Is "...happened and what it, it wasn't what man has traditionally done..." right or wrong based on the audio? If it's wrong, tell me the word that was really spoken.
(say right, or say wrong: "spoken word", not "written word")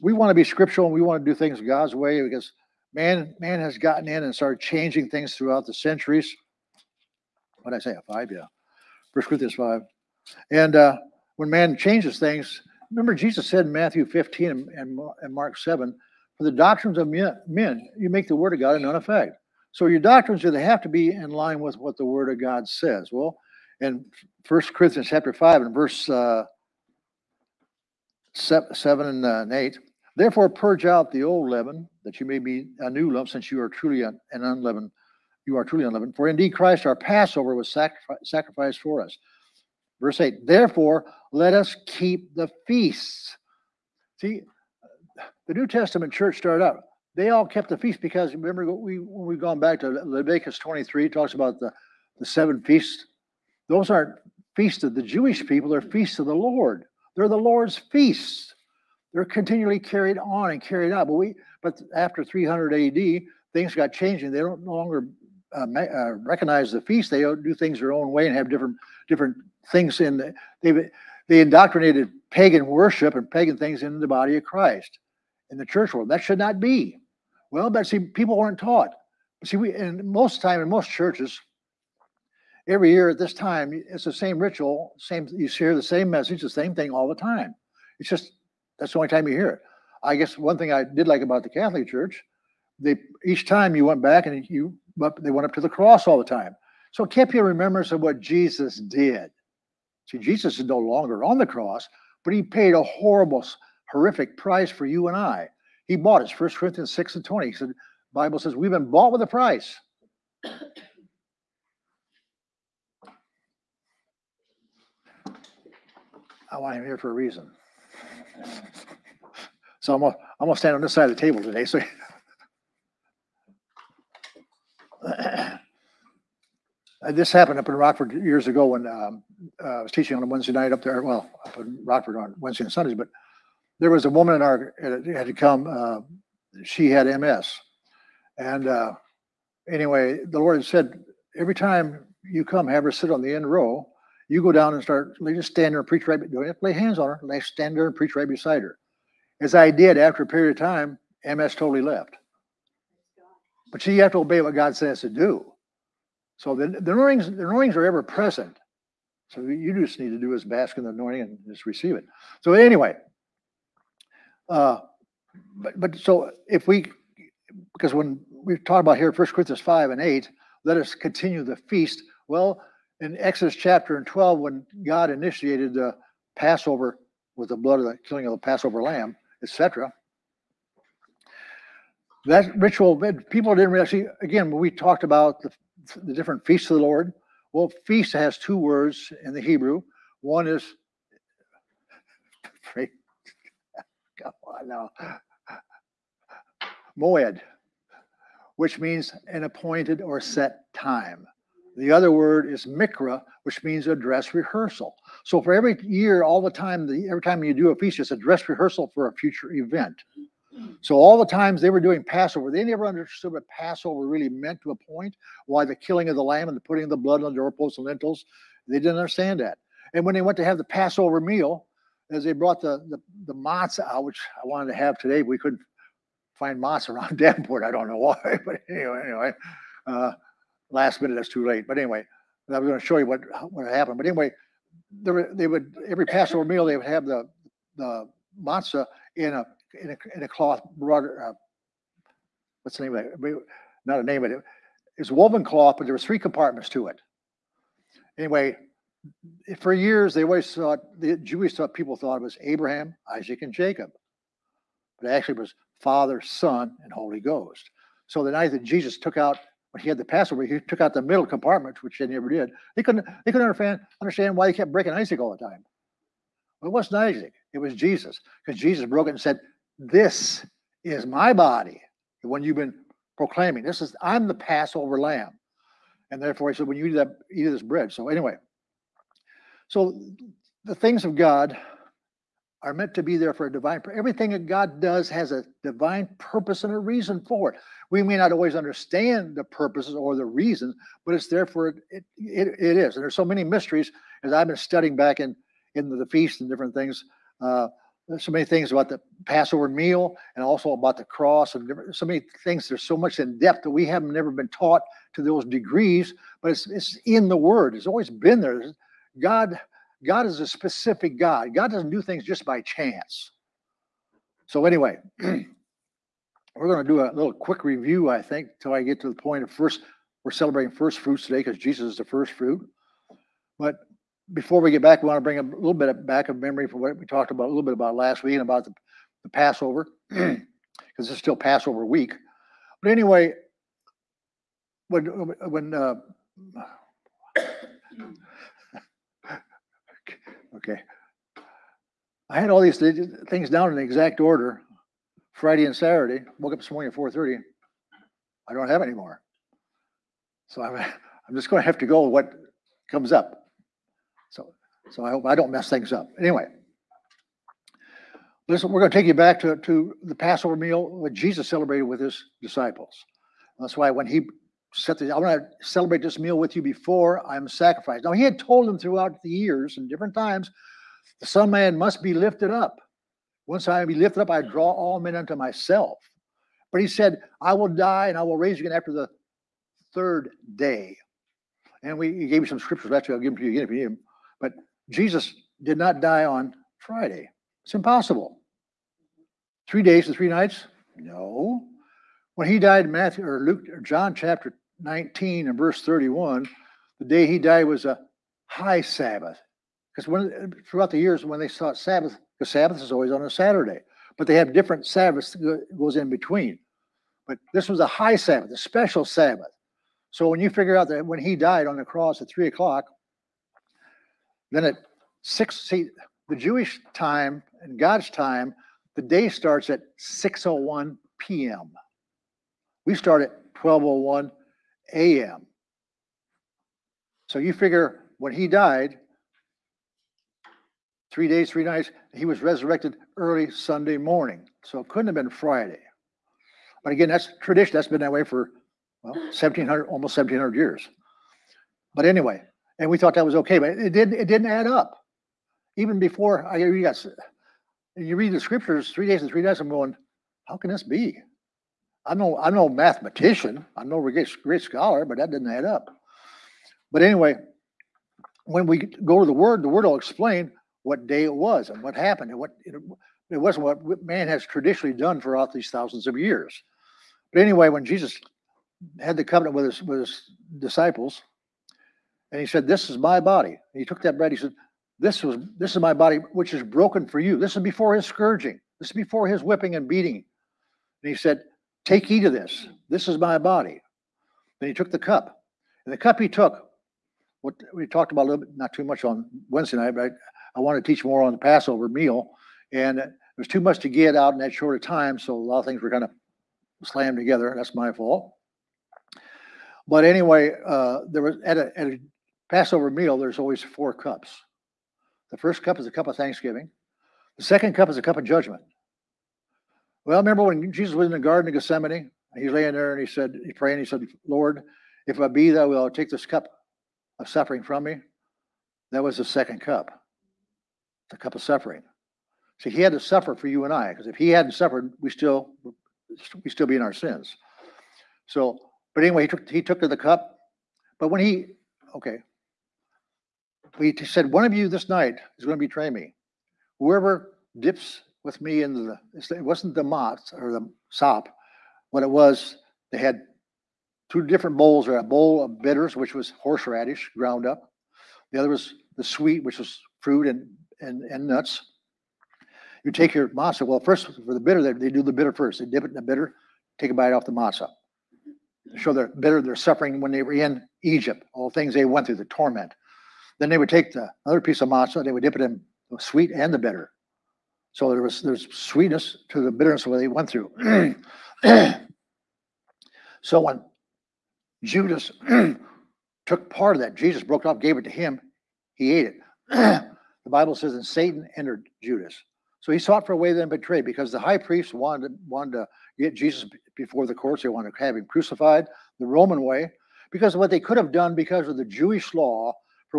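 right.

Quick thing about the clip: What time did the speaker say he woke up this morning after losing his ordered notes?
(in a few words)
4:30.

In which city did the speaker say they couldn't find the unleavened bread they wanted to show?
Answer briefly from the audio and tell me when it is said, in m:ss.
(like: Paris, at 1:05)
Davenport, at 3:47.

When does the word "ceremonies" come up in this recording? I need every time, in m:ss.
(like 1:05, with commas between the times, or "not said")
not said.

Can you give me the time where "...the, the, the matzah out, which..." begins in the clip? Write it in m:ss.
3:42.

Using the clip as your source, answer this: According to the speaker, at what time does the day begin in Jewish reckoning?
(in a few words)
6:01 p.m.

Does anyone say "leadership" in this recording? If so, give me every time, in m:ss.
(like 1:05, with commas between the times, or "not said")
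not said.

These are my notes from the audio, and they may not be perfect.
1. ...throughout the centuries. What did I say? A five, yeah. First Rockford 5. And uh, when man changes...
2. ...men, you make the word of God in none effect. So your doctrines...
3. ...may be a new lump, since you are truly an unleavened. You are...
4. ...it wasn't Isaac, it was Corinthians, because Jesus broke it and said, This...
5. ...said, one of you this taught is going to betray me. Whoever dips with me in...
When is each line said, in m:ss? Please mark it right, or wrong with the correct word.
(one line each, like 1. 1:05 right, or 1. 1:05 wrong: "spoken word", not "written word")
1. 0:05 wrong: "Corinthians", not "Rockford"
2. 0:17 right
3. 0:32 right
4. 4:26 wrong: "Jesus", not "Corinthians"
5. 8:54 wrong: "night", not "taught".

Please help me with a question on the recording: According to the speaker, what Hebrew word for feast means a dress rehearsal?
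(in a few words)
mikra.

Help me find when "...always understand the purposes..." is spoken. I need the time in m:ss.
4:48.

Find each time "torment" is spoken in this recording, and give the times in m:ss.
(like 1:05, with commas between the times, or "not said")
9:22.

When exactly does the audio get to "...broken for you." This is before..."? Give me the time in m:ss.
7:56.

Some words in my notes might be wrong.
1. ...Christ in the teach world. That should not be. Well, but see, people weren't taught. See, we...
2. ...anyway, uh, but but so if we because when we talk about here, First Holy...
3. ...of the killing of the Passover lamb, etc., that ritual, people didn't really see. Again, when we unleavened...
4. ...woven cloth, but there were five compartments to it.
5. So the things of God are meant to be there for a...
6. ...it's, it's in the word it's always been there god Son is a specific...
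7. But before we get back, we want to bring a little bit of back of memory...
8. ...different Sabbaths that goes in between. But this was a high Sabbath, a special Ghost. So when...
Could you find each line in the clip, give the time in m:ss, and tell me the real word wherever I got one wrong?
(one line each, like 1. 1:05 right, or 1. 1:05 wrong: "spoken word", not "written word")
1. 1:14 wrong: "church", not "teach"
2. 2:42 wrong: "Corinthians", not "Holy"
3. 2:57 wrong: "talked", not "unleavened"
4. 4:05 wrong: "three", not "five"
5. 4:39 right
6. 5:06 wrong: "God", not "Son"
7. 5:23 right
8. 6:44 wrong: "Sabbath", not "Ghost".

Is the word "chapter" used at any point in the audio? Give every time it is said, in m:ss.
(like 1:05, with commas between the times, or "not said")
0:25, 2:53, 6:34.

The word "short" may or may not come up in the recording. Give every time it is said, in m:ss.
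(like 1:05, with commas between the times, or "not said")
8:14.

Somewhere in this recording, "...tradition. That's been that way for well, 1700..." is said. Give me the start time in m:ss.
7:17.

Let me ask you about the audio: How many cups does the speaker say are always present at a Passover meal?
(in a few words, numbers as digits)
4.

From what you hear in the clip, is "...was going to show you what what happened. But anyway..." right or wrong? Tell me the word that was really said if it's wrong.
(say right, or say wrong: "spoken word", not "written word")
right.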